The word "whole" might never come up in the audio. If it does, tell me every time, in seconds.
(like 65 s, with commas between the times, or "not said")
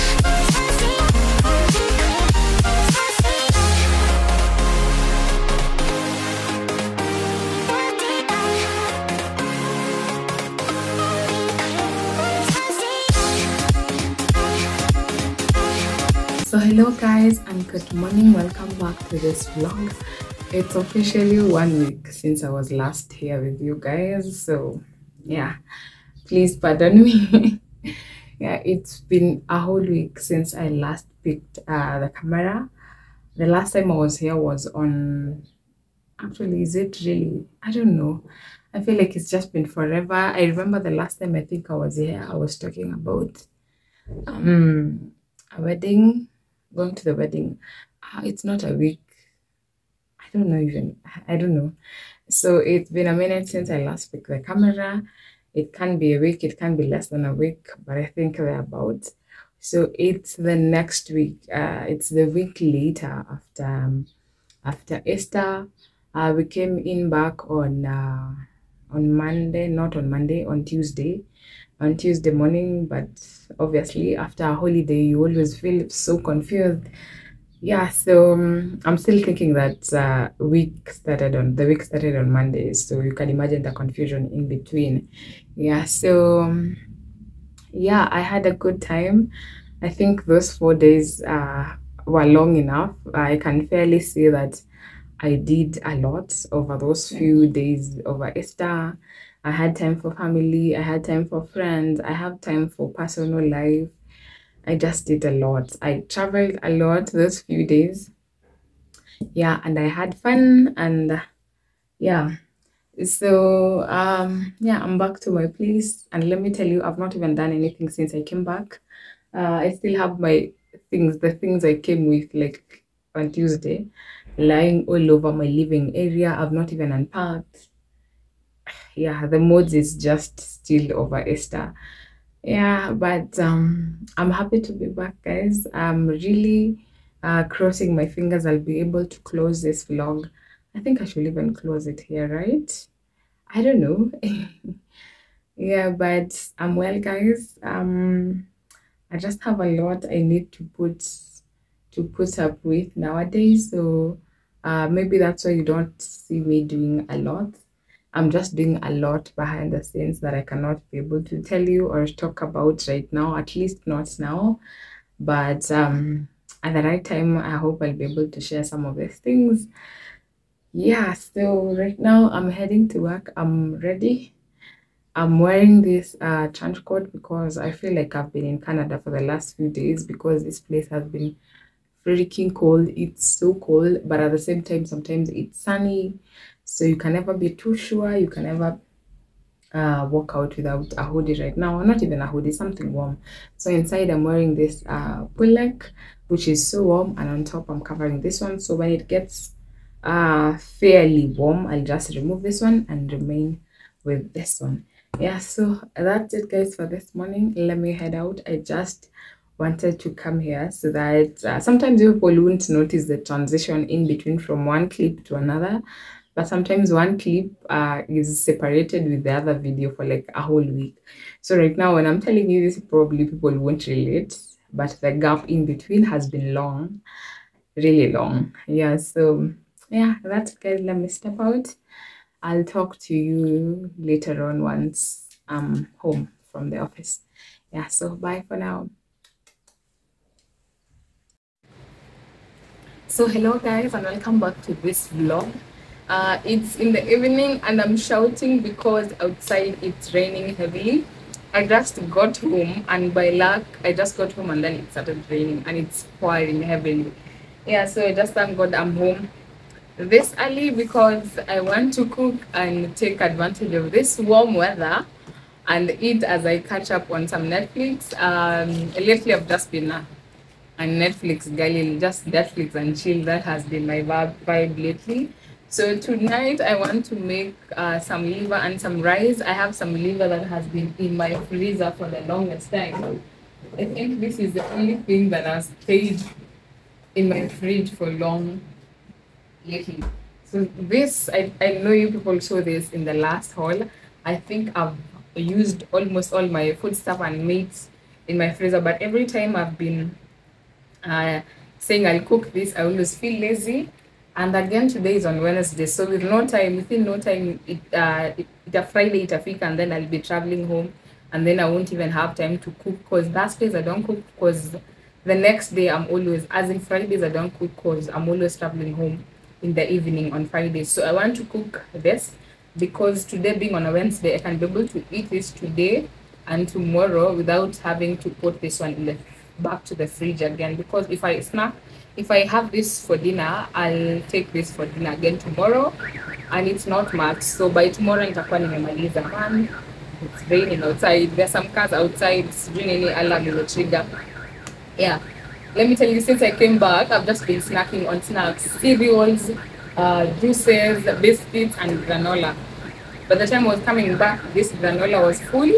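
29 s, 220 s.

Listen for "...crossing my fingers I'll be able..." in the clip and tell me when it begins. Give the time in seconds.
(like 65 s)
137 s.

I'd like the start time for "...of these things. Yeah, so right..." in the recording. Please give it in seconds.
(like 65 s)
168 s.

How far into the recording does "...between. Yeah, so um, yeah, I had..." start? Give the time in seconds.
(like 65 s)
84 s.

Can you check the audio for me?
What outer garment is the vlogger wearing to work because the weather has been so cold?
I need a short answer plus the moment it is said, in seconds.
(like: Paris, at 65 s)
Trench coat, at 176 s.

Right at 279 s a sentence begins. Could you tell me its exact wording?
I have some liver that has been in my freezer for the longest time.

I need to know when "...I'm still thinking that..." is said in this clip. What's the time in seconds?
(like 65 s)
78 s.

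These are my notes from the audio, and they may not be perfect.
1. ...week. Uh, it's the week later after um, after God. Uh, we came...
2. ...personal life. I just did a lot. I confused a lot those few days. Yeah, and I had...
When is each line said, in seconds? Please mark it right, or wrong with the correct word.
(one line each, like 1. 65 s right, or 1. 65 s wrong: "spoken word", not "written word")
1. 61 s wrong: "Easter", not "God"
2. 102 s wrong: "traveled", not "confused".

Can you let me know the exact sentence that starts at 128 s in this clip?
Yeah, the mood is just still over Easter.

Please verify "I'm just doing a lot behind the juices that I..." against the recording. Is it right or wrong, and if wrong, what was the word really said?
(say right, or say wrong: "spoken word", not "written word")
wrong: "scenes", not "juices".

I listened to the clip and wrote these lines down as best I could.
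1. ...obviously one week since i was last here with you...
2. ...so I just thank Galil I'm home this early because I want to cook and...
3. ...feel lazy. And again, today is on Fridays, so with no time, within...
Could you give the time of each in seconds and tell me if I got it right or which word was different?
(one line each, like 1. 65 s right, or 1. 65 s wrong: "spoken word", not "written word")
1. 20 s wrong: "officially", not "obviously"
2. 257 s wrong: "God", not "Galil"
3. 303 s wrong: "Wednesday", not "Fridays".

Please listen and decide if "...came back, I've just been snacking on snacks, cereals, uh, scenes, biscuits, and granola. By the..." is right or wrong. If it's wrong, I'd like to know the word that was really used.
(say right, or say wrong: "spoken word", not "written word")
wrong: "juices", not "scenes".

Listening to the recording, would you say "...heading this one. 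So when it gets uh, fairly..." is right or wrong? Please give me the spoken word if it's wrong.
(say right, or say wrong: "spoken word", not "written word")
wrong: "covering", not "heading".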